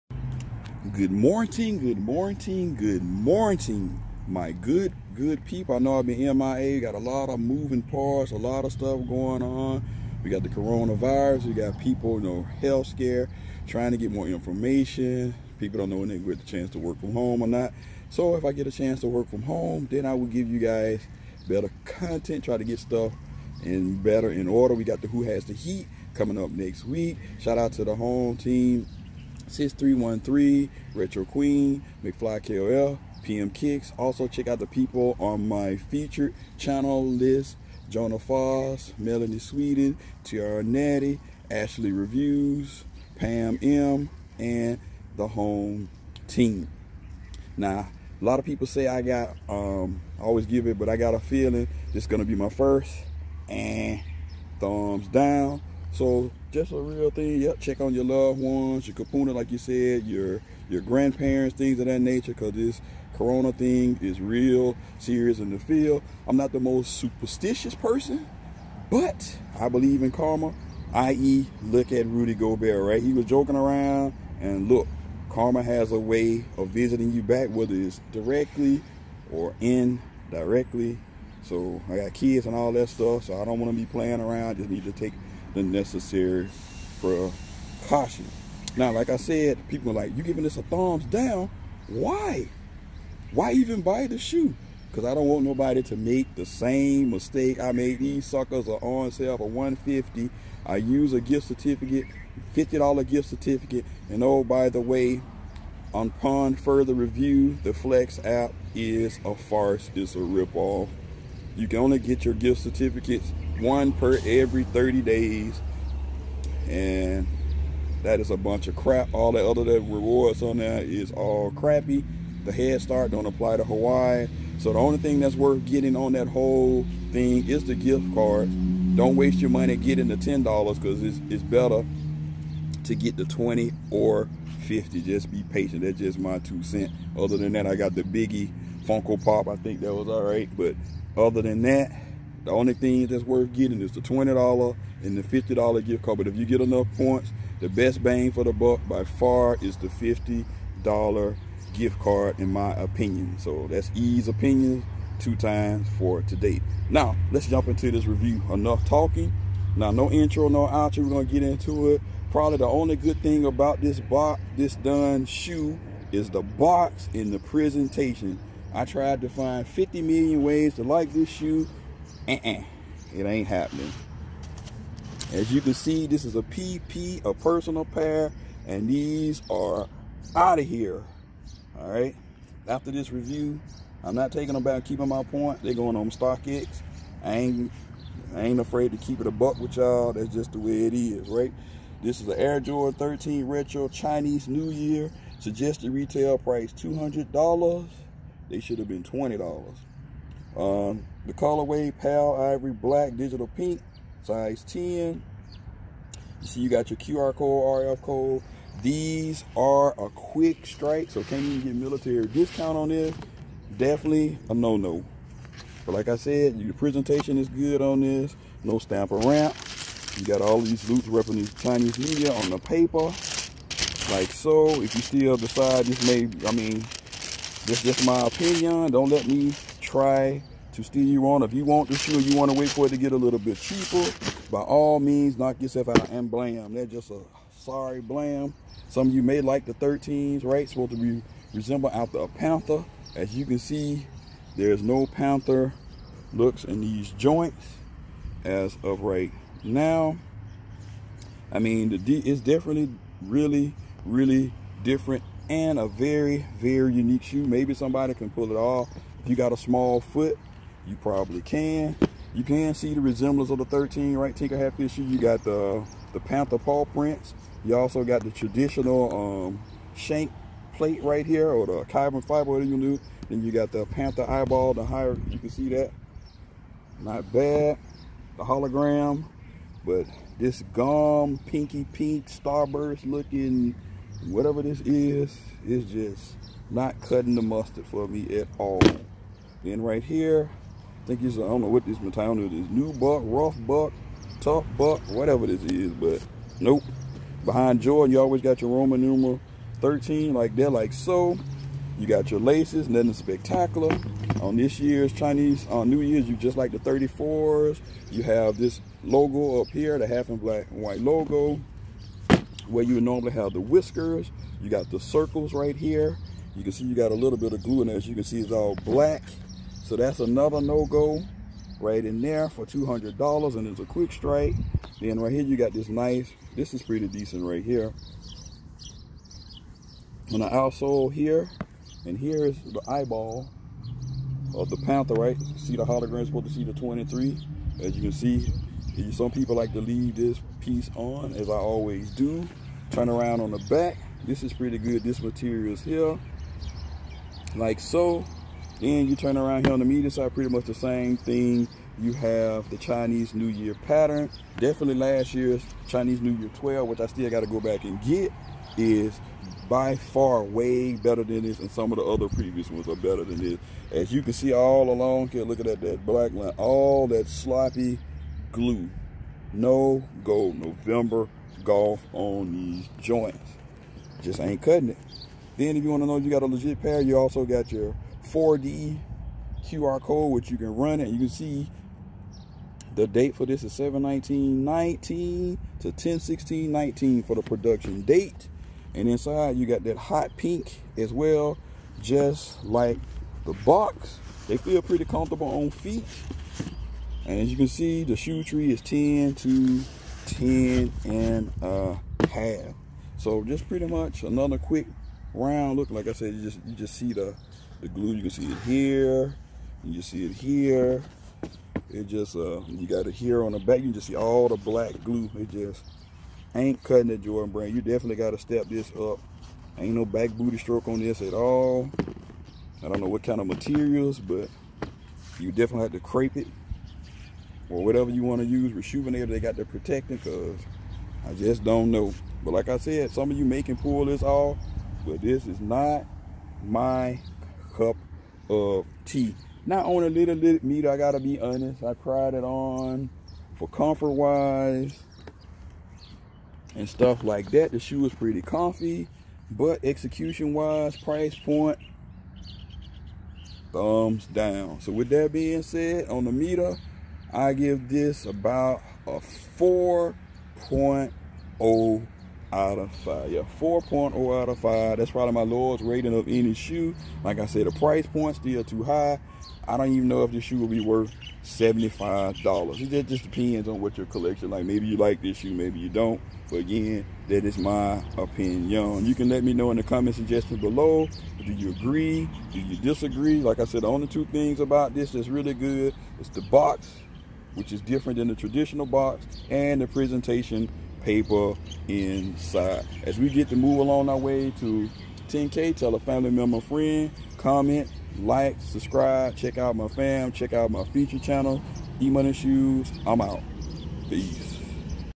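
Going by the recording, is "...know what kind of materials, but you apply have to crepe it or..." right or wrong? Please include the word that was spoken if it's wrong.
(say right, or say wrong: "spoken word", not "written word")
wrong: "definitely", not "apply".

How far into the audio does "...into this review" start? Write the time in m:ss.
2:37.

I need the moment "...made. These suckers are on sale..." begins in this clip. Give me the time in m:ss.
1:37.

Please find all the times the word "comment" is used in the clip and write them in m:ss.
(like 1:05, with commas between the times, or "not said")
7:59, 8:17.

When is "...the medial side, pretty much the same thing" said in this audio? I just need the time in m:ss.
5:49.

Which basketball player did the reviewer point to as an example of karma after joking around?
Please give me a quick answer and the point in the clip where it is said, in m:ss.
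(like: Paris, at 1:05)
Rudy Gobert, at 1:12.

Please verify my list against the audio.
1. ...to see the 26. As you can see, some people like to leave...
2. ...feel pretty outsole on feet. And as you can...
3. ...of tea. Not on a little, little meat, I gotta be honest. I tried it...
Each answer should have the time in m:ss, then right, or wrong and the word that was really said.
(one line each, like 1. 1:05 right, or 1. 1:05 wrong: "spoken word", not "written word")
1. 5:36 wrong: "23", not "26"
2. 6:34 wrong: "comfortable", not "outsole"
3. 7:18 right.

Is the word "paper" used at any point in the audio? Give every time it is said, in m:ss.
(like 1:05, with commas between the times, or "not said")
3:42, 8:11.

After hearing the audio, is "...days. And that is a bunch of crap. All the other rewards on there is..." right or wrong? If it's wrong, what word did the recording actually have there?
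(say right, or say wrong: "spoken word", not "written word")
right.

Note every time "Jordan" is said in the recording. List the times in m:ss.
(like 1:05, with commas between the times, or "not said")
3:12, 4:57, 6:57.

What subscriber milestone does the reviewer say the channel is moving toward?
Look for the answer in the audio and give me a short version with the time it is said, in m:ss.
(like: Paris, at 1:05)
10K, at 8:15.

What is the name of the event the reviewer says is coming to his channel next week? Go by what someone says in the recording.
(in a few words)
Who Has the Heat.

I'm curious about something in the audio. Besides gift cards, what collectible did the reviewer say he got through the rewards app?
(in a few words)
Biggie Funko Pop.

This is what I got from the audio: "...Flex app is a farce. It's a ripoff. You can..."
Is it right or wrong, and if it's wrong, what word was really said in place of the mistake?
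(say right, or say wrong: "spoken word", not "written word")
right.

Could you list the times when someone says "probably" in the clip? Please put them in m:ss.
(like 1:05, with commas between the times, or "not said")
2:42, 4:20, 7:45.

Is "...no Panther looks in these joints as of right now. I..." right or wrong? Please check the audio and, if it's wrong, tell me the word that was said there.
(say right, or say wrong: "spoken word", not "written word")
right.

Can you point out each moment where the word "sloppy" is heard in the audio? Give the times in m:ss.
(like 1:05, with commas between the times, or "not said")
6:07.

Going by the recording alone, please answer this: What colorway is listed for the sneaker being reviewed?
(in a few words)
Pale Ivory Black Digital Pink.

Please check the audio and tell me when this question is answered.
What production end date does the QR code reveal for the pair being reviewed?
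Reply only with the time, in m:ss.
6:25.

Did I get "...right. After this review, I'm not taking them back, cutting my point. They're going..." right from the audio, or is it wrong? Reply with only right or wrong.
wrong.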